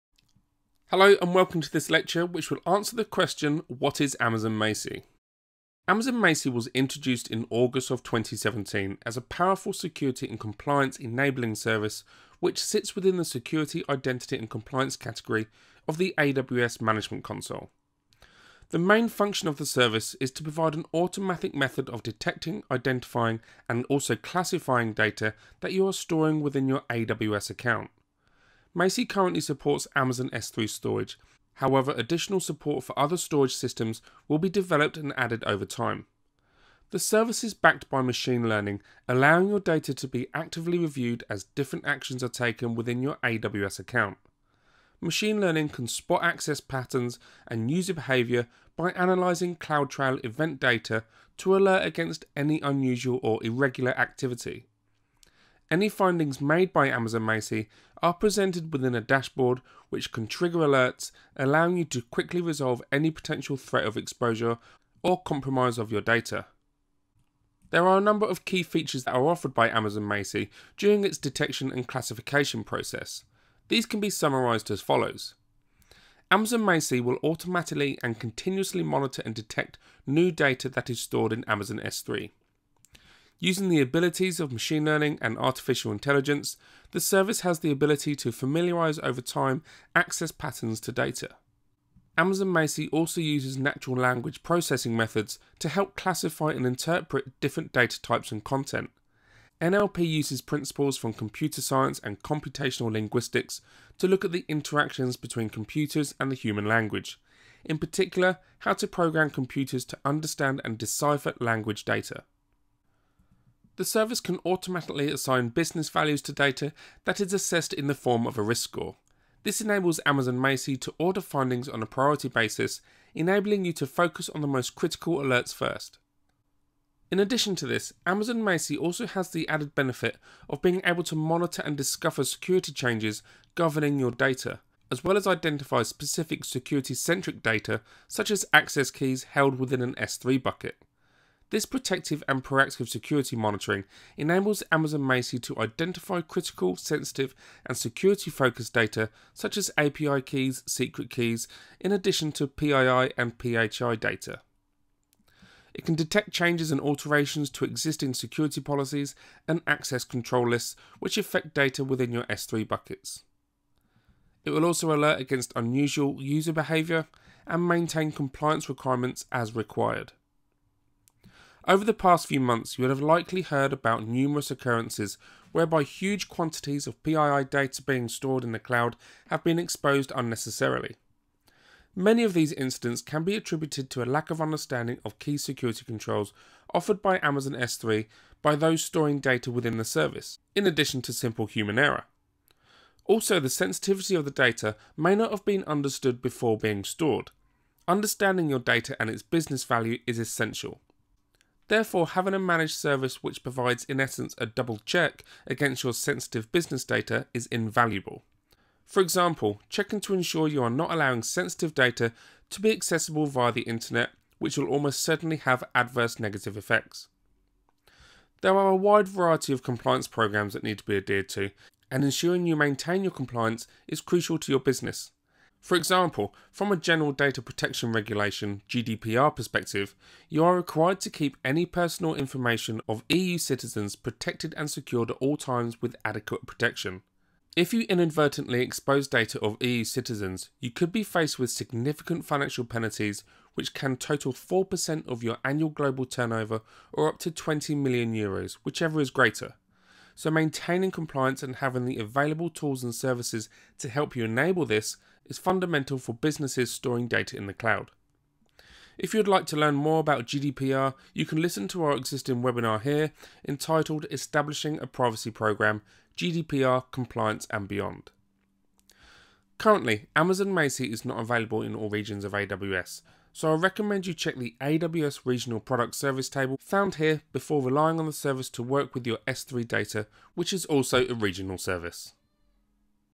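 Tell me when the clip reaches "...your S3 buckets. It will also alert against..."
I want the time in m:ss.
2:42.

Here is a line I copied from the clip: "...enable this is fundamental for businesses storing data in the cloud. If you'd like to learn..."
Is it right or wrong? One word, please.
right.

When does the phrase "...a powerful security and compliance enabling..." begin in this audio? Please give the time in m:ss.
0:09.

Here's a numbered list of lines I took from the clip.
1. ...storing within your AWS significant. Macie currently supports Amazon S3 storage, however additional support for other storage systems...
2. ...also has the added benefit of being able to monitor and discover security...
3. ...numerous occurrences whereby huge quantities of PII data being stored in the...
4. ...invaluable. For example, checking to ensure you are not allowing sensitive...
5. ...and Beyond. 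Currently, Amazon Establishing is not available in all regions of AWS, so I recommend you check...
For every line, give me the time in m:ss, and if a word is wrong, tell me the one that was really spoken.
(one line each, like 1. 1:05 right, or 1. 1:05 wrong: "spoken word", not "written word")
1. 0:25 wrong: "account", not "significant"
2. 2:08 right
3. 2:54 right
4. 3:27 right
5. 4:27 wrong: "Macie", not "Establishing".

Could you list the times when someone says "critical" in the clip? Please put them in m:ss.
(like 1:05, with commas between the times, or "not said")
2:04, 2:26.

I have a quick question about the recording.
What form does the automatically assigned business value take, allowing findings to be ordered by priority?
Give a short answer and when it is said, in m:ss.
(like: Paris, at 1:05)
A risk score, at 1:58.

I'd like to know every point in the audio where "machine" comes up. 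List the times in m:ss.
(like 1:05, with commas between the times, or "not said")
0:38, 0:44, 1:24.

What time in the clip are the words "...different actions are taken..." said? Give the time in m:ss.
0:41.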